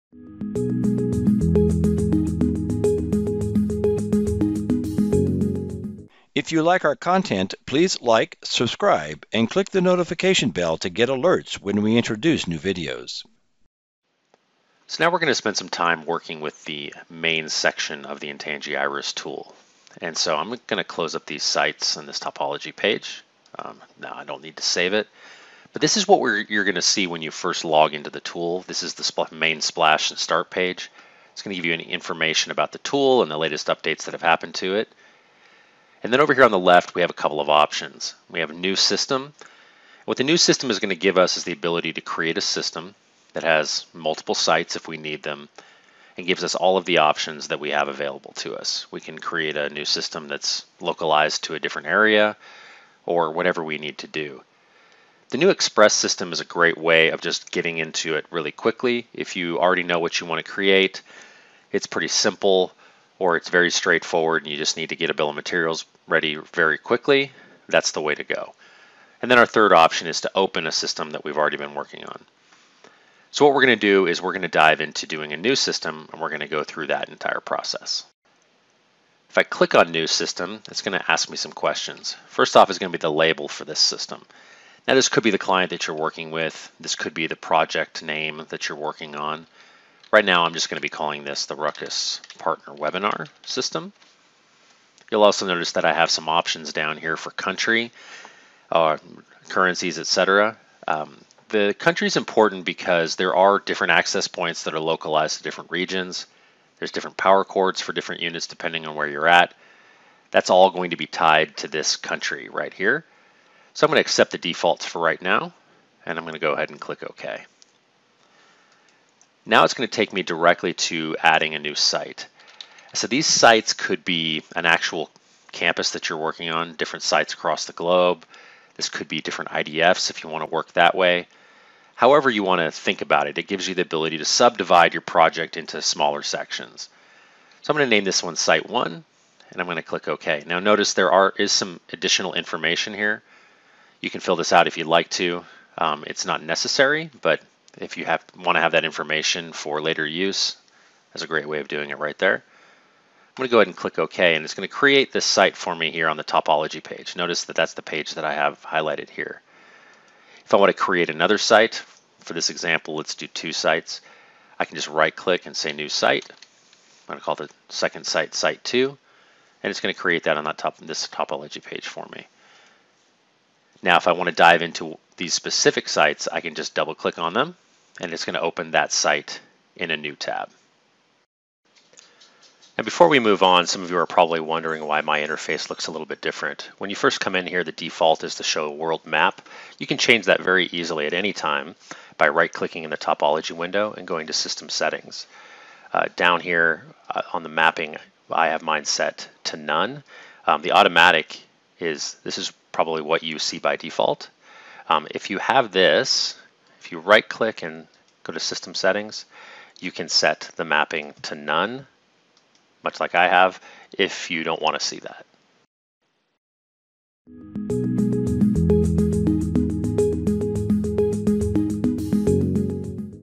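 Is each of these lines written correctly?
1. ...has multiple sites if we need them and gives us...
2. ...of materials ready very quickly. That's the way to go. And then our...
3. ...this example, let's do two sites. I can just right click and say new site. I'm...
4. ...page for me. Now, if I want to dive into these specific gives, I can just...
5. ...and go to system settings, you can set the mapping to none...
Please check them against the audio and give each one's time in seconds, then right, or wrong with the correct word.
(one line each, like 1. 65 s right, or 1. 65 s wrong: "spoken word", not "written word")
1. 43 s right
2. 65 s right
3. 162 s right
4. 171 s wrong: "sites", not "gives"
5. 207 s right.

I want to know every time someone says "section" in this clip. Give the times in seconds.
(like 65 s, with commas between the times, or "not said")
17 s, 136 s.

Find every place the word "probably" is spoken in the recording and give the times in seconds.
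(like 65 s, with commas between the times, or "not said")
184 s, 202 s.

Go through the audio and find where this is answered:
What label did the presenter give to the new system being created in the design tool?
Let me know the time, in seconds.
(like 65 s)
91 s.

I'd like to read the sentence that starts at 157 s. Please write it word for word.
Notice that that's the page that I have highlighted here.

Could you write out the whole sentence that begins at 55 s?
The new Express system is a great way of just getting into it really quickly.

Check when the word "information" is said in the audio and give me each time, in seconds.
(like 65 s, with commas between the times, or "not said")
31 s, 142 s, 148 s.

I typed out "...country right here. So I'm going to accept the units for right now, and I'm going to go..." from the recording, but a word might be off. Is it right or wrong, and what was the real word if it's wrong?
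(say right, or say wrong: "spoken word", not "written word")
wrong: "defaults", not "units".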